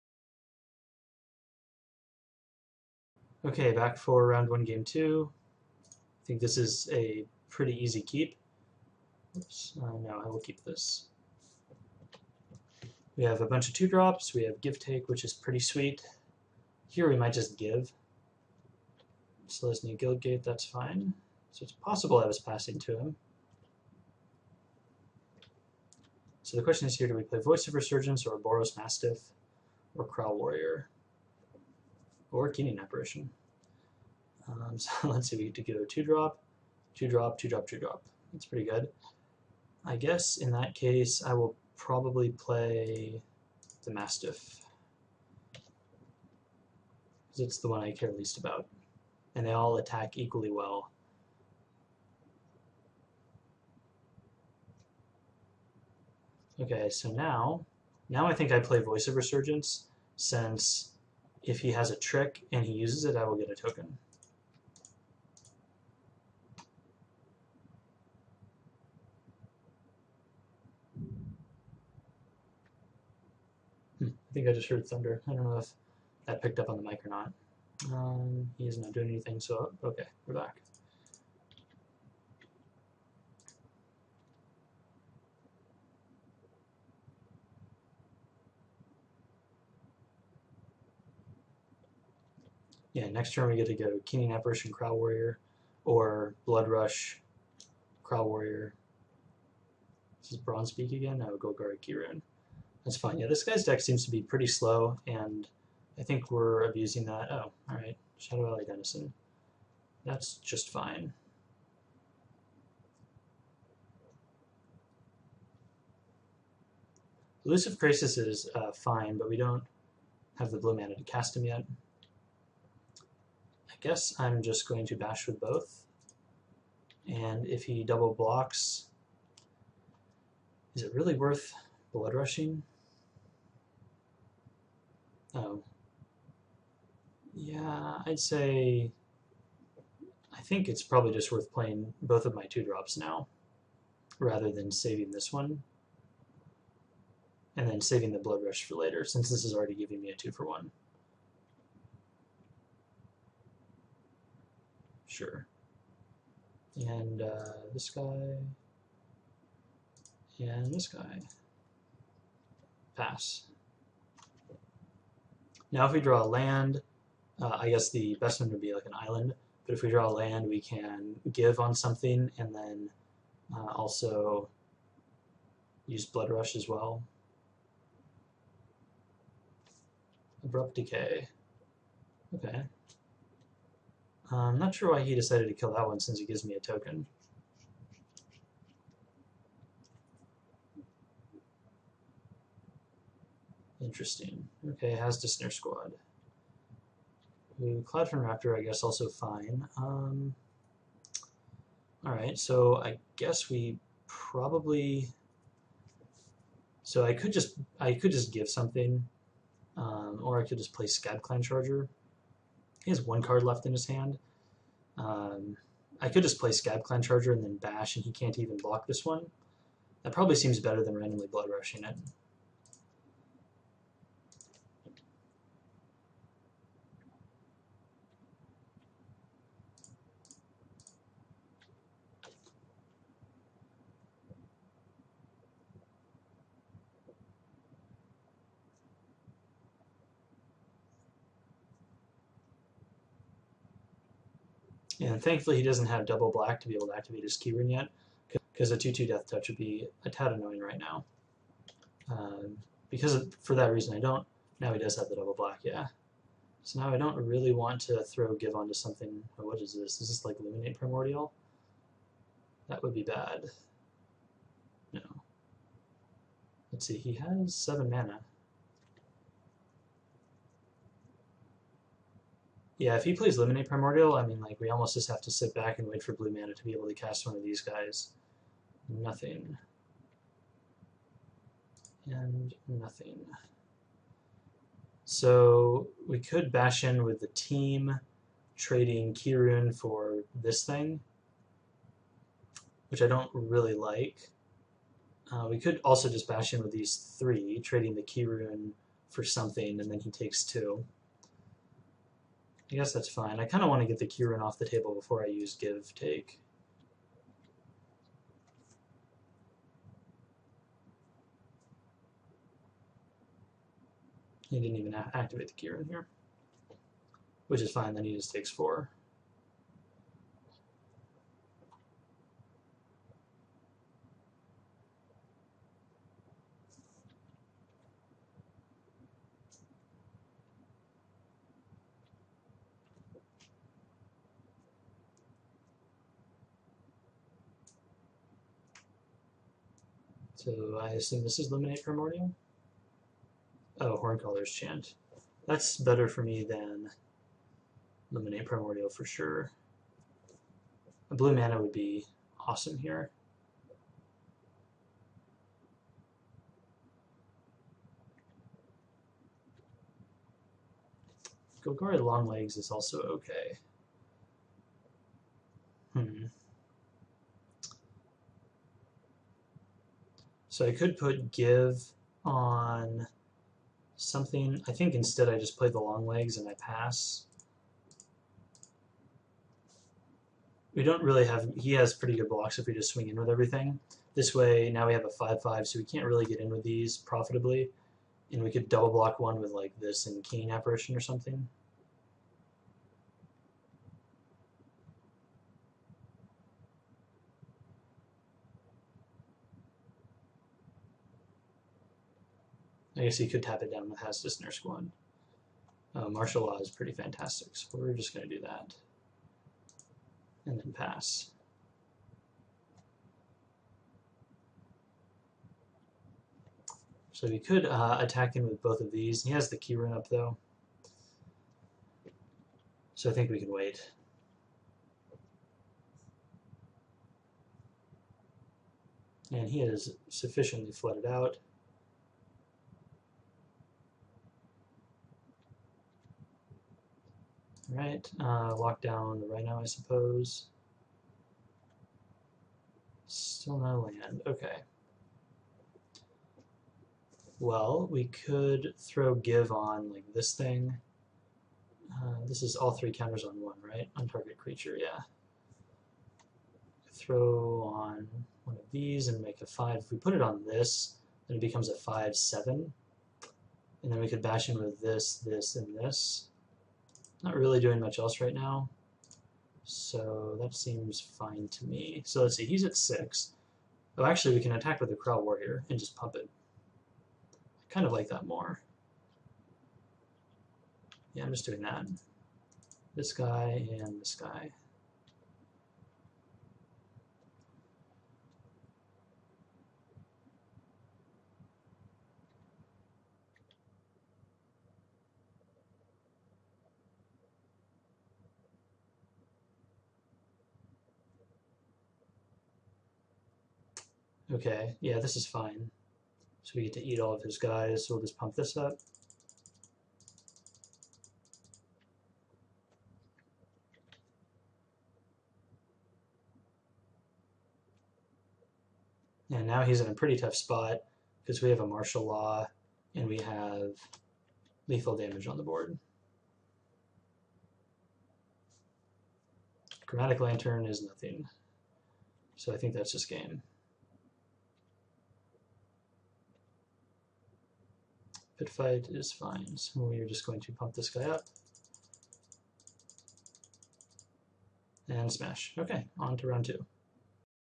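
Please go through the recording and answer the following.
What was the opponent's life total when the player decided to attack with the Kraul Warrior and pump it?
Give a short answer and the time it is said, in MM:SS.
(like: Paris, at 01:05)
6, at 07:52.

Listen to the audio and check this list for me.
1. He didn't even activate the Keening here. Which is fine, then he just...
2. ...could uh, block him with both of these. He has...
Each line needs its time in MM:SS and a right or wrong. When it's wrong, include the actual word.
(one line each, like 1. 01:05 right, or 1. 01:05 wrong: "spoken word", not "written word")
1. 05:14 wrong: "Keyrune", not "Keening"
2. 06:57 wrong: "attack", not "block".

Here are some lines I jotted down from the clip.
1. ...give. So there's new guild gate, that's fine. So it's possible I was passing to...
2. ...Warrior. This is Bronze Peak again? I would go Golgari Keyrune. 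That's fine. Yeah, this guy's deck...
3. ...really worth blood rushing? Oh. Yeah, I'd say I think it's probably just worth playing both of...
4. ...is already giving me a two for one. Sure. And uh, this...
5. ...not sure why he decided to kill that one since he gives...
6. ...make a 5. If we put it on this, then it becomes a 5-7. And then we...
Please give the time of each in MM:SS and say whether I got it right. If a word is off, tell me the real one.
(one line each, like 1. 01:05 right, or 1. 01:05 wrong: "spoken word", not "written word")
1. 00:17 right
2. 01:38 right
3. 02:10 right
4. 02:29 right
5. 03:04 right
6. 07:39 right.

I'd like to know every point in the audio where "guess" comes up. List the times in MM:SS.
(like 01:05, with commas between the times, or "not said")
00:39, 02:03, 02:47, 03:18, 03:23, 05:02, 06:43.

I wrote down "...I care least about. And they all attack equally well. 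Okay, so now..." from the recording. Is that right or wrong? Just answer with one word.
right.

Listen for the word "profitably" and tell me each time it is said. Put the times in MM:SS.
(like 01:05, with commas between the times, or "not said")
06:26.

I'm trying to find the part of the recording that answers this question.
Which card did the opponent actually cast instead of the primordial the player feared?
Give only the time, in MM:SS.
05:43.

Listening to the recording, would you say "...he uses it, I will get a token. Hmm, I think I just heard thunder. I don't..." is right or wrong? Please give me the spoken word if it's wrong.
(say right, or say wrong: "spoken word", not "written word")
right.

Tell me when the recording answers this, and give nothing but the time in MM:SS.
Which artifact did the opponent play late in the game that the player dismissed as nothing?
08:49.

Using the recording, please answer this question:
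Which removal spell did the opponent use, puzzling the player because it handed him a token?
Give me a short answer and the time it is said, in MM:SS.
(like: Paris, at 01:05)
Abrupt Decay, at 03:00.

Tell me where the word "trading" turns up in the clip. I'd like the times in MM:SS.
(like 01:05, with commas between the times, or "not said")
04:48, 04:57.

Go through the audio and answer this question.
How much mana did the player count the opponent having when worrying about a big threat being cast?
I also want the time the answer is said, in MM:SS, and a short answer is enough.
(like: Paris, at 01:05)
7, at 04:27.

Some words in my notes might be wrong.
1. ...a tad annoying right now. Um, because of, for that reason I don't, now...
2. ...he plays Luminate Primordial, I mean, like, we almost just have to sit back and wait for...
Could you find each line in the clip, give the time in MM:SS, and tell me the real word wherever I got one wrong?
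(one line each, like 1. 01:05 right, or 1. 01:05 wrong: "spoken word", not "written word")
1. 04:10 right
2. 04:33 right.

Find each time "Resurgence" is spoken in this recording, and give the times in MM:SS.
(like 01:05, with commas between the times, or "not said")
00:27, 00:59.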